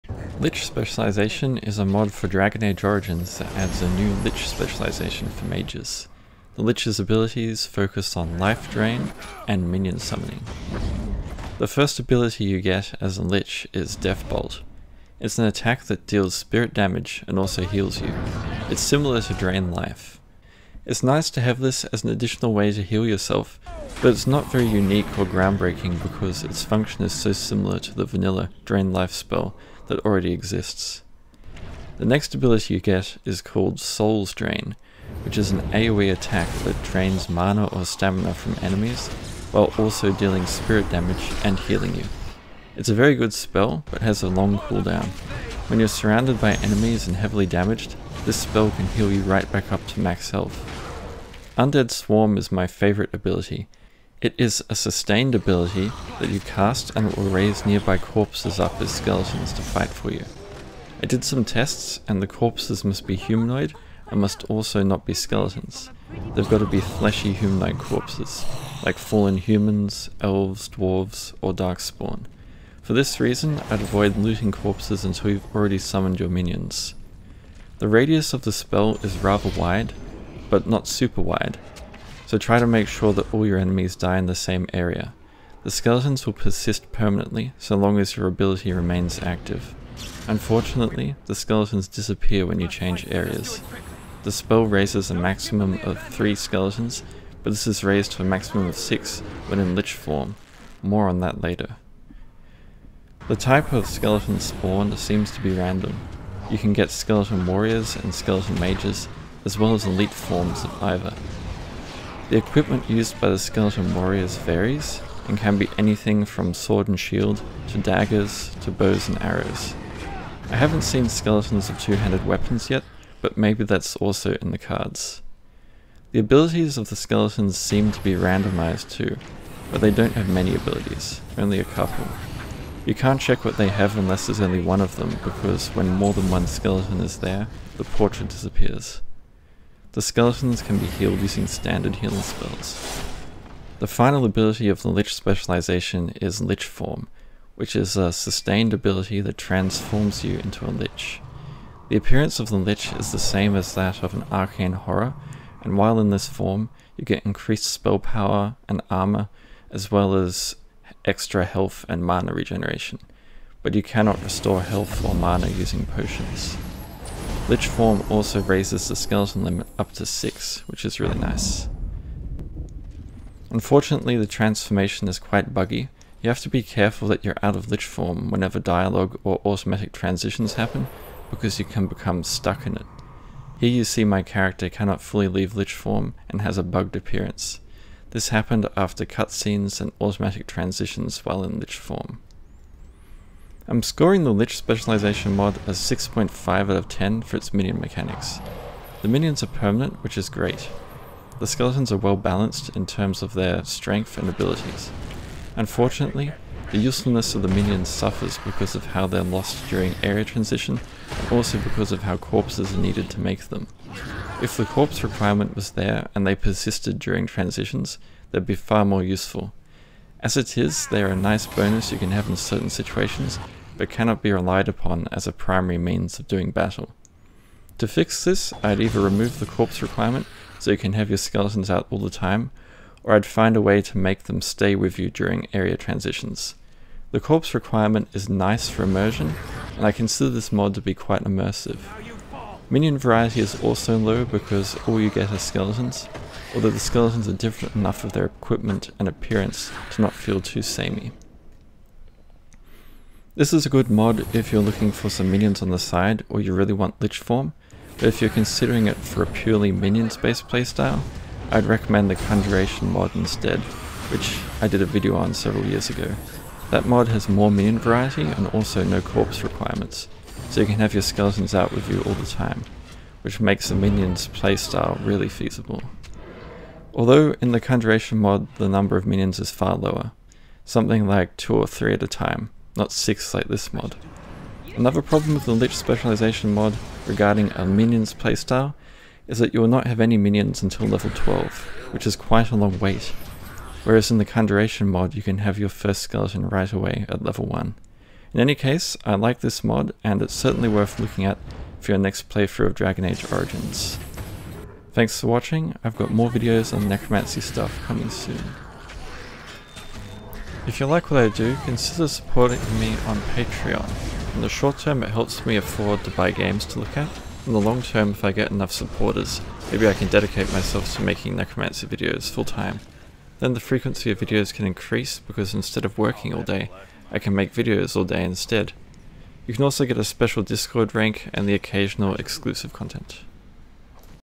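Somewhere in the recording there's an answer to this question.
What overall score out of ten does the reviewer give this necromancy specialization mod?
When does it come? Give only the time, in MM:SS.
03:15.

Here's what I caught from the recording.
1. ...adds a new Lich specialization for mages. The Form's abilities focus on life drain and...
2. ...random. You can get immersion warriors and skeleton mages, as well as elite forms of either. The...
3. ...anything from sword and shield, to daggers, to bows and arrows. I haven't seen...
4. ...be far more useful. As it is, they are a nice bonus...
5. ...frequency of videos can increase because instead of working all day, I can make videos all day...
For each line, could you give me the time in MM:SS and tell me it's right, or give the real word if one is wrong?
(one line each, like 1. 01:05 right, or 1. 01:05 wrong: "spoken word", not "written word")
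1. 00:03 wrong: "Lich", not "Form"
2. 01:45 wrong: "skeleton", not "immersion"
3. 01:55 right
4. 03:38 right
5. 05:23 right.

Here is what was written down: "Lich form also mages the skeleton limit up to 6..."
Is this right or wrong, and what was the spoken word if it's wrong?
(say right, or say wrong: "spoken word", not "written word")
wrong: "raises", not "mages".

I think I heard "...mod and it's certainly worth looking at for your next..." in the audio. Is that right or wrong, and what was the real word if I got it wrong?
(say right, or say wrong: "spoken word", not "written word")
right.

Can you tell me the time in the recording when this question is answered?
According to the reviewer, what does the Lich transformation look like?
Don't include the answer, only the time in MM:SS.
02:34.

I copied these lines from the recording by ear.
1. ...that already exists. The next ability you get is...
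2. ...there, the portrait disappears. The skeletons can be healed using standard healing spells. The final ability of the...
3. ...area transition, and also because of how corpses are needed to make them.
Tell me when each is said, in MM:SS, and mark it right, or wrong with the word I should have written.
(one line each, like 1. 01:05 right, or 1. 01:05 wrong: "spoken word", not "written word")
1. 00:29 right
2. 02:17 right
3. 03:30 right.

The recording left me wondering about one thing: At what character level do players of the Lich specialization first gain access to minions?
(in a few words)
12.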